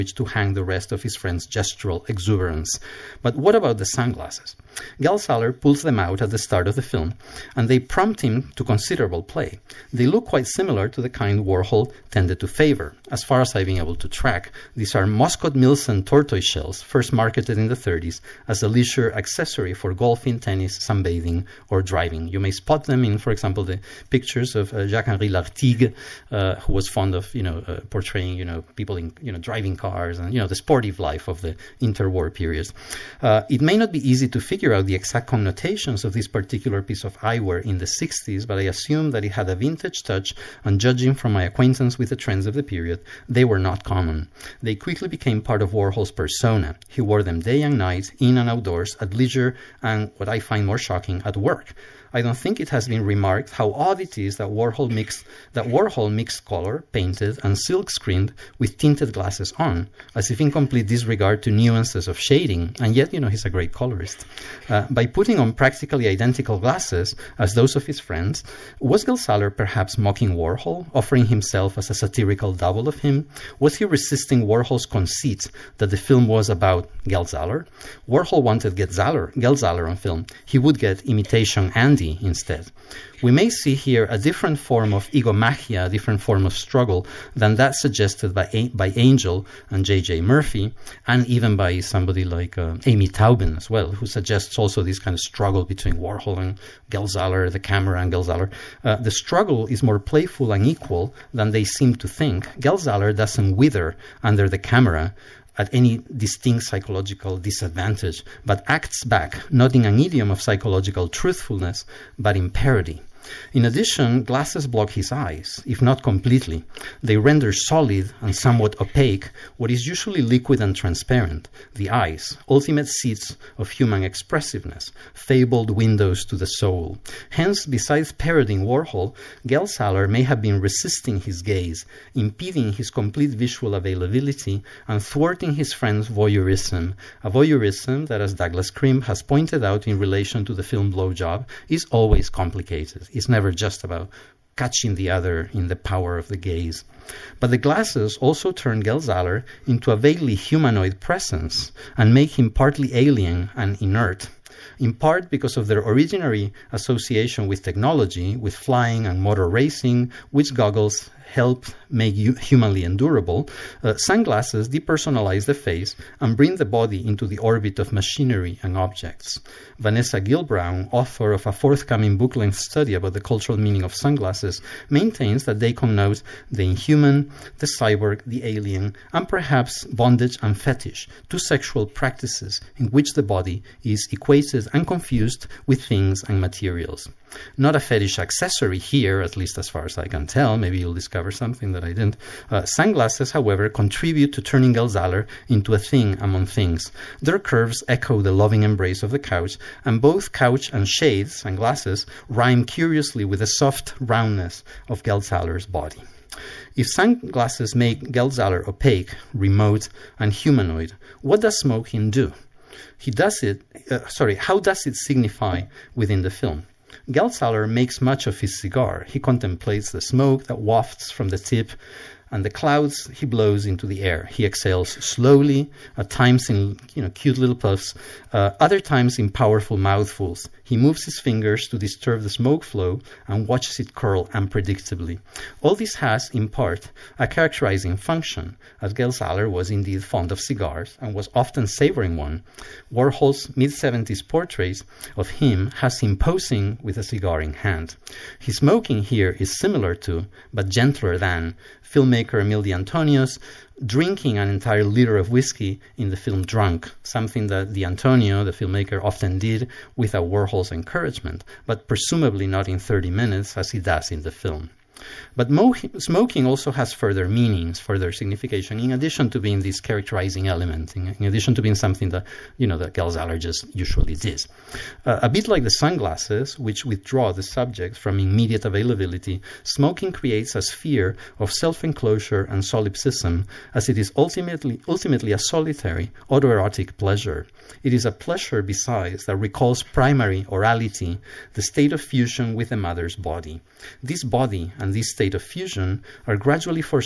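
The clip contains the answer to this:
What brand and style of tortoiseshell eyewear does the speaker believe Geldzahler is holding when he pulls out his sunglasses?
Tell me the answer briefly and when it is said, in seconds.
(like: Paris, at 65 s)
Muscat Milson, at 15 s.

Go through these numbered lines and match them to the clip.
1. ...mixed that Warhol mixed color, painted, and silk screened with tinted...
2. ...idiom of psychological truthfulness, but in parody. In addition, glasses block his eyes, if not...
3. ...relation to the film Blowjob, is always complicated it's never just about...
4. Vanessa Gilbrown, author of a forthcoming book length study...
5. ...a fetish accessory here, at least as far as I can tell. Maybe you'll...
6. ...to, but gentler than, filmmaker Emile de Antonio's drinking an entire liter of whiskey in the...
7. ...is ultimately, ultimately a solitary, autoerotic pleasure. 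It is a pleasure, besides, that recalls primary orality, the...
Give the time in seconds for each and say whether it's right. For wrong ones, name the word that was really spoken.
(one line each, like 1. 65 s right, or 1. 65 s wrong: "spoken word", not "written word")
1. 54 s right
2. 109 s right
3. 139 s right
4. 169 s right
5. 187 s right
6. 250 s right
7. 283 s right.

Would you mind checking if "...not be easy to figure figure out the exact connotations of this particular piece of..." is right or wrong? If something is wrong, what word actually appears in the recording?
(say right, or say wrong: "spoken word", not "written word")
right.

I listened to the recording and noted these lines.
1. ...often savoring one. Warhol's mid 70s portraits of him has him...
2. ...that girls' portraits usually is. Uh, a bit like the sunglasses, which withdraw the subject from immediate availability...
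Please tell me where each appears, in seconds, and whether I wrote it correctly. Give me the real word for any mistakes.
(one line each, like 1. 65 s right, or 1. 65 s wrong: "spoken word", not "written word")
1. 241 s right
2. 272 s wrong: "allergists", not "portraits".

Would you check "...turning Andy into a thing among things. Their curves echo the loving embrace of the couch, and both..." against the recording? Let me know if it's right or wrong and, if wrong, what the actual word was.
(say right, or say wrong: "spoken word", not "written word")
wrong: "Geldzahler", not "Andy".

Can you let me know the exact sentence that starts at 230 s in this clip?
He moves his fingers to disturb the smoke flow and watches it curl unpredictably.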